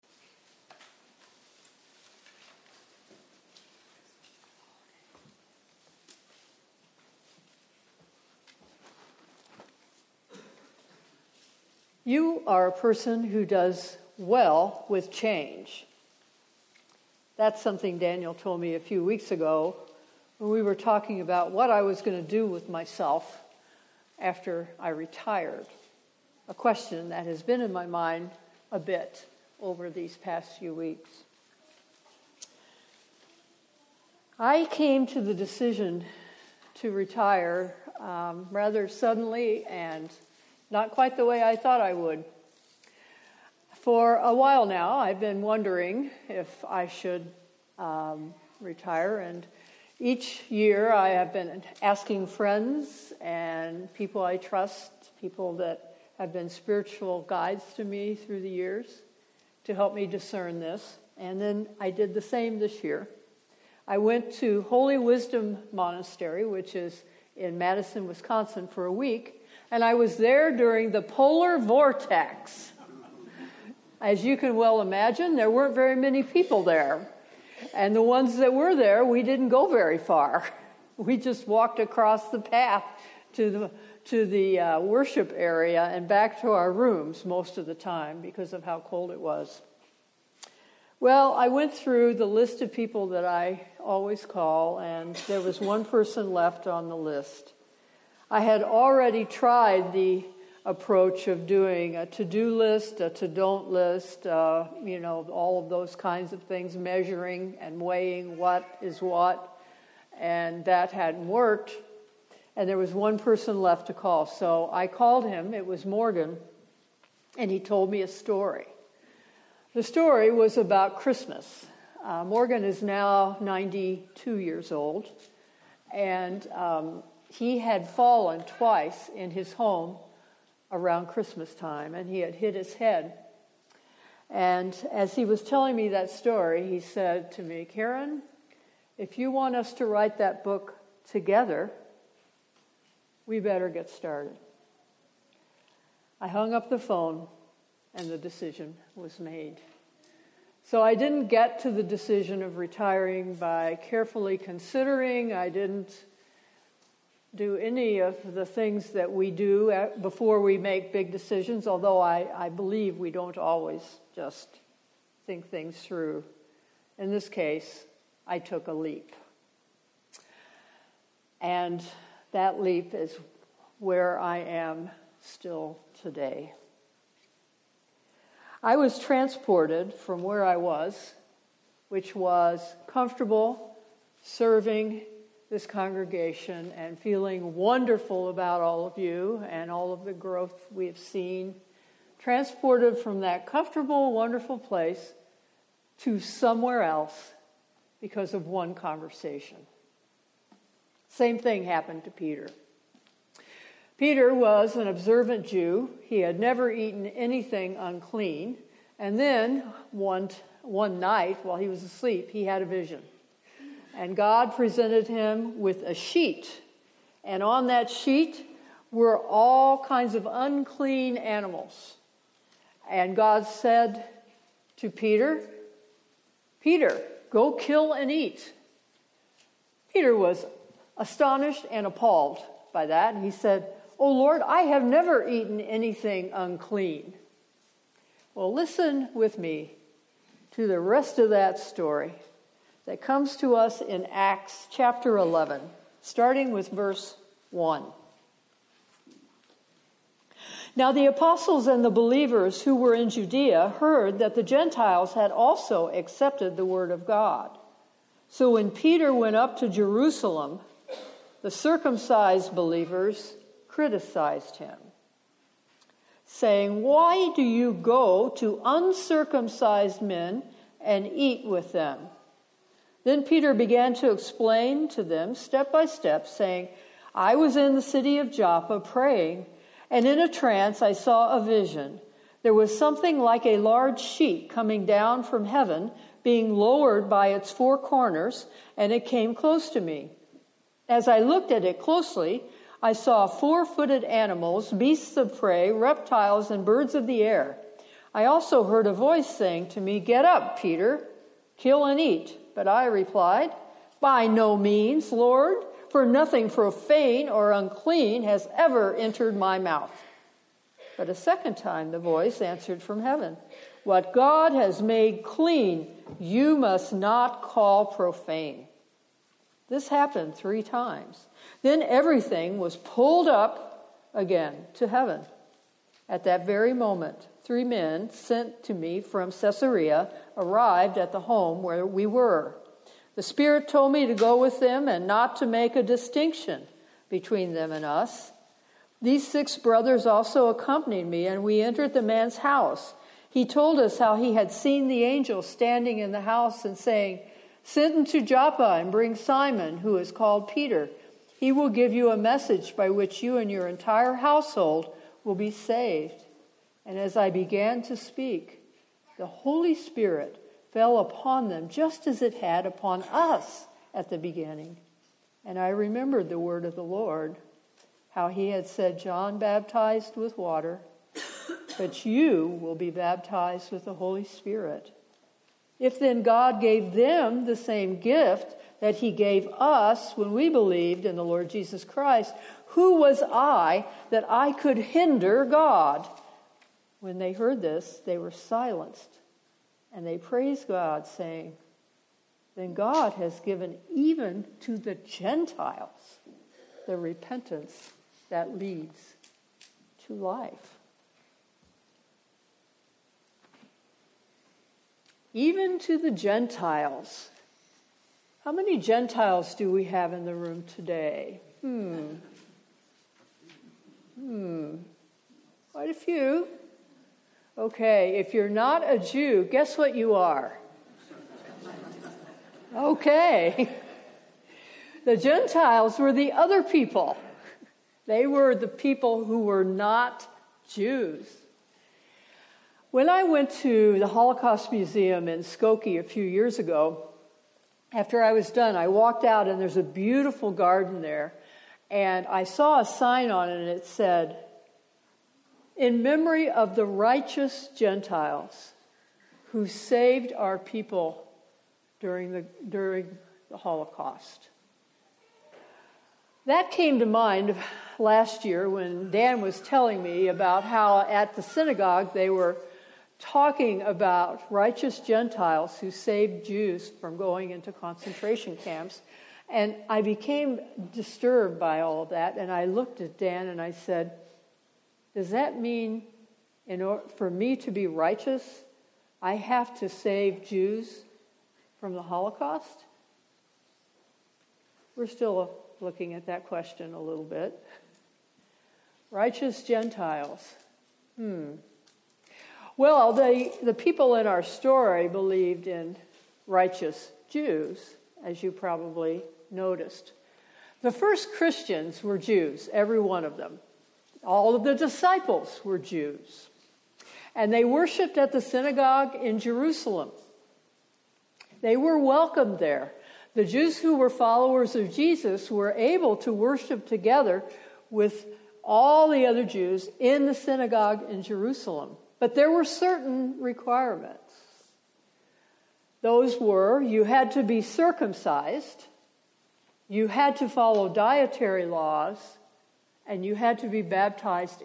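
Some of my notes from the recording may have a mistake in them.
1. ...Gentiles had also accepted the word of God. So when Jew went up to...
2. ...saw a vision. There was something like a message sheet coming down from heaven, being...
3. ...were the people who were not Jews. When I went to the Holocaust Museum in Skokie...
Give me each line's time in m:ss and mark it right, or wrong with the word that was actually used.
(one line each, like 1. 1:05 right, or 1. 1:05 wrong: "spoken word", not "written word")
1. 4:14 wrong: "Peter", not "Jew"
2. 4:40 wrong: "large", not "message"
3. 7:08 right.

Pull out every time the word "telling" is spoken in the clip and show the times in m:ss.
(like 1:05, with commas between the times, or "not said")
2:15, 7:39.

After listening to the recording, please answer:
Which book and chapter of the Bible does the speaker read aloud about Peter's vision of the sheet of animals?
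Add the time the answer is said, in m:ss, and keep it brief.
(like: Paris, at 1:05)
Acts chapter 11, at 4:04.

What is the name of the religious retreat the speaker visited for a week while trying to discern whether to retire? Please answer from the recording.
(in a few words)
Holy Wisdom Monastery.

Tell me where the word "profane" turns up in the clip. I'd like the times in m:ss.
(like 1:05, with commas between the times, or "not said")
5:06, 5:17.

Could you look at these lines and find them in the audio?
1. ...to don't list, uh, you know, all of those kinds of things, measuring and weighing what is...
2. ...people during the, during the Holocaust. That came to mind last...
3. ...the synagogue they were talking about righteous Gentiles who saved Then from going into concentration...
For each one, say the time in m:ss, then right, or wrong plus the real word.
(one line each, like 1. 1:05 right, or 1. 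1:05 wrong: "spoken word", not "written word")
1. 1:43 right
2. 7:30 right
3. 7:41 wrong: "Jews", not "Then".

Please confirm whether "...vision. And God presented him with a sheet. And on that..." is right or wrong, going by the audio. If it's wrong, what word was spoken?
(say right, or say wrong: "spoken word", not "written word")
right.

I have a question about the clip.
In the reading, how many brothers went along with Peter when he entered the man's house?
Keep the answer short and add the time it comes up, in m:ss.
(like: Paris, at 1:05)
6, at 5:39.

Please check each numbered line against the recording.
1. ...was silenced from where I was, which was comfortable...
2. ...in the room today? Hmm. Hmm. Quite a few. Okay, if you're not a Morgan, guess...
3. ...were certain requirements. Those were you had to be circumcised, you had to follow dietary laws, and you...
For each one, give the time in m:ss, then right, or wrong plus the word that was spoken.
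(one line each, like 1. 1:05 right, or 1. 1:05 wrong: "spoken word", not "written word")
1. 2:58 wrong: "transported", not "silenced"
2. 6:50 wrong: "Jew", not "Morgan"
3. 8:42 right.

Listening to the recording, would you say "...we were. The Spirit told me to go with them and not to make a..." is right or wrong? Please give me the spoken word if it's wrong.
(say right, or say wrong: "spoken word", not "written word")
right.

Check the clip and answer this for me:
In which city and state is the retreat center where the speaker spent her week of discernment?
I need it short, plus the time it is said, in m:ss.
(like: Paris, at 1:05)
Madison, Wisconsin, at 1:07.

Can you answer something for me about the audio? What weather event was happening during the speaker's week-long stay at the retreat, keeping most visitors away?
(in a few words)
Polar vortex.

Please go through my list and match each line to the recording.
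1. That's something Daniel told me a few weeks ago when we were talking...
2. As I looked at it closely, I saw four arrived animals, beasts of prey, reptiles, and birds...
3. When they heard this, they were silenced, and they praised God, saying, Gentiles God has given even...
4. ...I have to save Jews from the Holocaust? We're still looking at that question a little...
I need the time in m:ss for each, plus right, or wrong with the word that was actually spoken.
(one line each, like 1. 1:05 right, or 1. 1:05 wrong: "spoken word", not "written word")
1. 0:17 right
2. 4:50 wrong: "footed", not "arrived"
3. 6:26 wrong: "Then", not "Gentiles"
4. 7:59 right.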